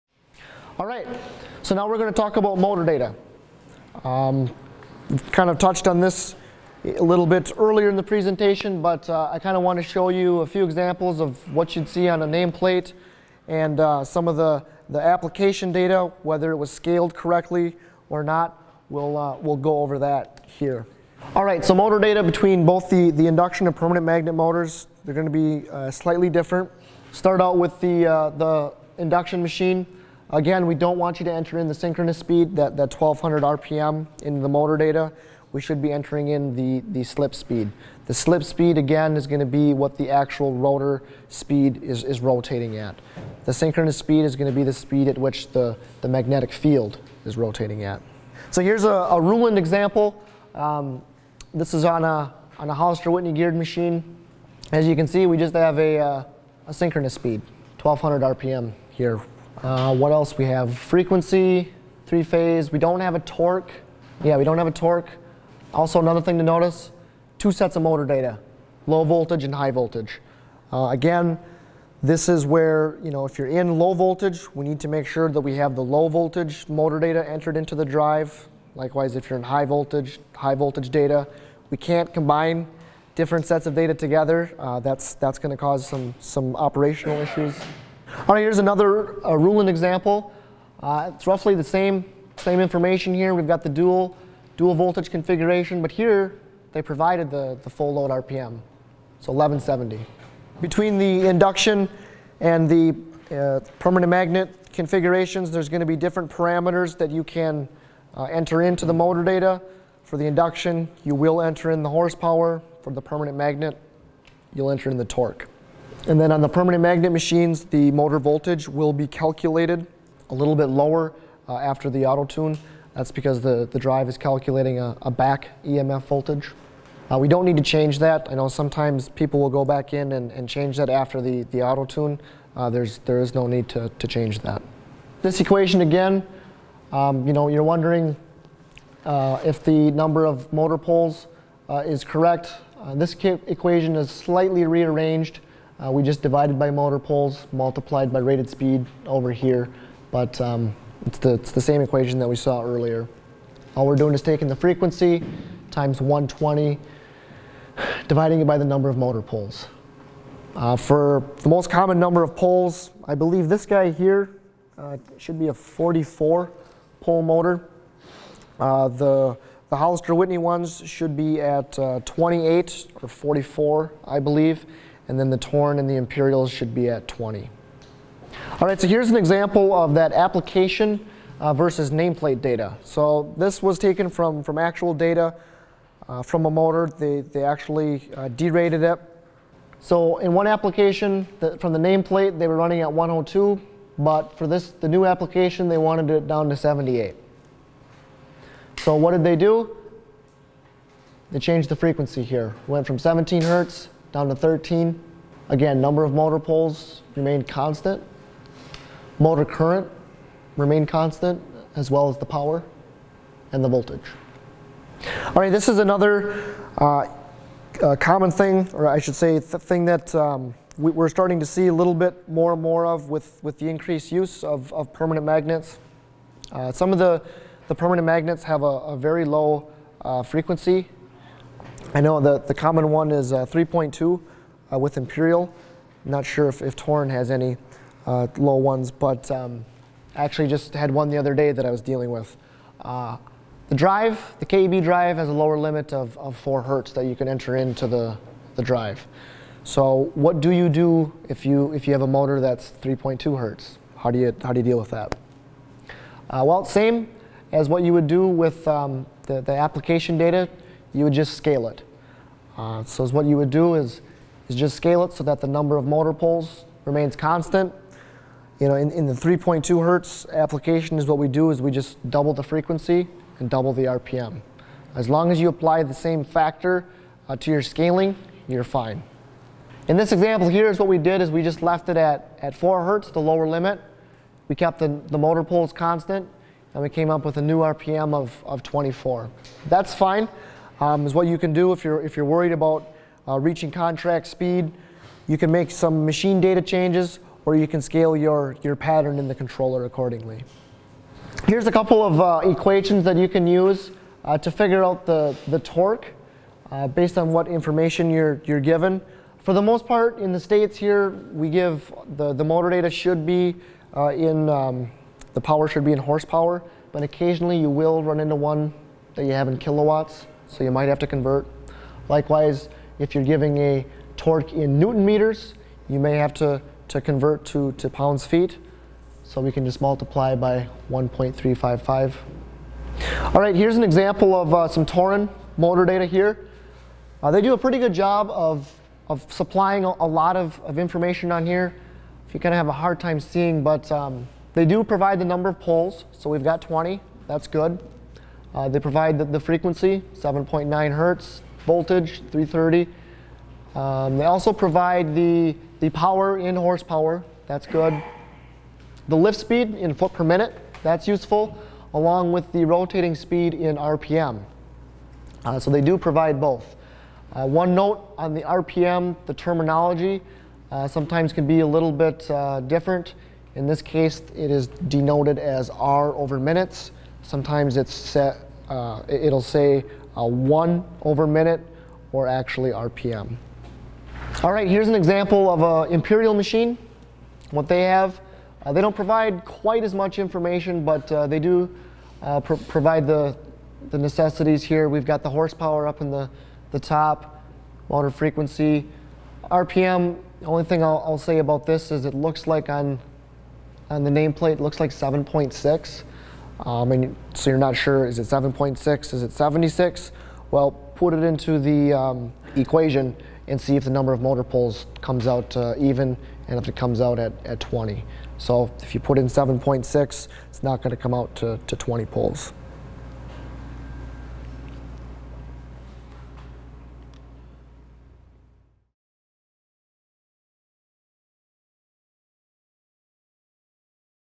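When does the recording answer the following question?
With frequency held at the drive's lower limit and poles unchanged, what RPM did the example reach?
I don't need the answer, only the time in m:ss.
4:48.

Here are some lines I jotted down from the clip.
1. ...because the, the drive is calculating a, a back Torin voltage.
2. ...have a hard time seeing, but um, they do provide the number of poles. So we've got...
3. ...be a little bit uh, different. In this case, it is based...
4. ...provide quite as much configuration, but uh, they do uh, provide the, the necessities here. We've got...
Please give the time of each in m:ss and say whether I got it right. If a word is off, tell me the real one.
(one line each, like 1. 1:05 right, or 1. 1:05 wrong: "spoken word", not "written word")
1. 2:03 wrong: "EMF", not "Torin"
2. 5:42 right
3. 6:11 wrong: "denoted", not "based"
4. 6:28 wrong: "information", not "configuration".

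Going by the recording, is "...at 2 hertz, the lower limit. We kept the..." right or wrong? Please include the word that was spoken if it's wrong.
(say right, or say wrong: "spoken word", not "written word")
wrong: "4", not "2".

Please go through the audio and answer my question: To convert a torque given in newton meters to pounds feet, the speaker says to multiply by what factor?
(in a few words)
1.355.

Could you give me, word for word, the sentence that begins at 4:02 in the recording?
The drive, the KEB drive, has a lower limit of, of 4 hertz that you can enter into the, the drive.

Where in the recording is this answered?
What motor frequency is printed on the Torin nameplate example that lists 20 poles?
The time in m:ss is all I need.
5:50.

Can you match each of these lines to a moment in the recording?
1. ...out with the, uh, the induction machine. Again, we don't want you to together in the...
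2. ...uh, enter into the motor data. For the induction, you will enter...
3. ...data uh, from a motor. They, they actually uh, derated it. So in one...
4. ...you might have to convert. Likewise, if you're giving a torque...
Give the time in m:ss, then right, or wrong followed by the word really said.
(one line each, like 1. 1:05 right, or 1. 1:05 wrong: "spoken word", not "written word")
1. 0:27 wrong: "enter", not "together"
2. 1:48 right
3. 3:04 right
4. 5:20 right.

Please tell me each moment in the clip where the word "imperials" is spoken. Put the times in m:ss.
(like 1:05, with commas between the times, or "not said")
2:55, 3:54, 6:25.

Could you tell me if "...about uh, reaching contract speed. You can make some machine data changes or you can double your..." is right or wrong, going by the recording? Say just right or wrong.
wrong.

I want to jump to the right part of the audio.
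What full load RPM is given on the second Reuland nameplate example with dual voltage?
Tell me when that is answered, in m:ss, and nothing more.
1:39.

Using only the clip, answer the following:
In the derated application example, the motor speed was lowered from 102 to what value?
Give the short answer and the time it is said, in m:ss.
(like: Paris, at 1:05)
78, at 3:16.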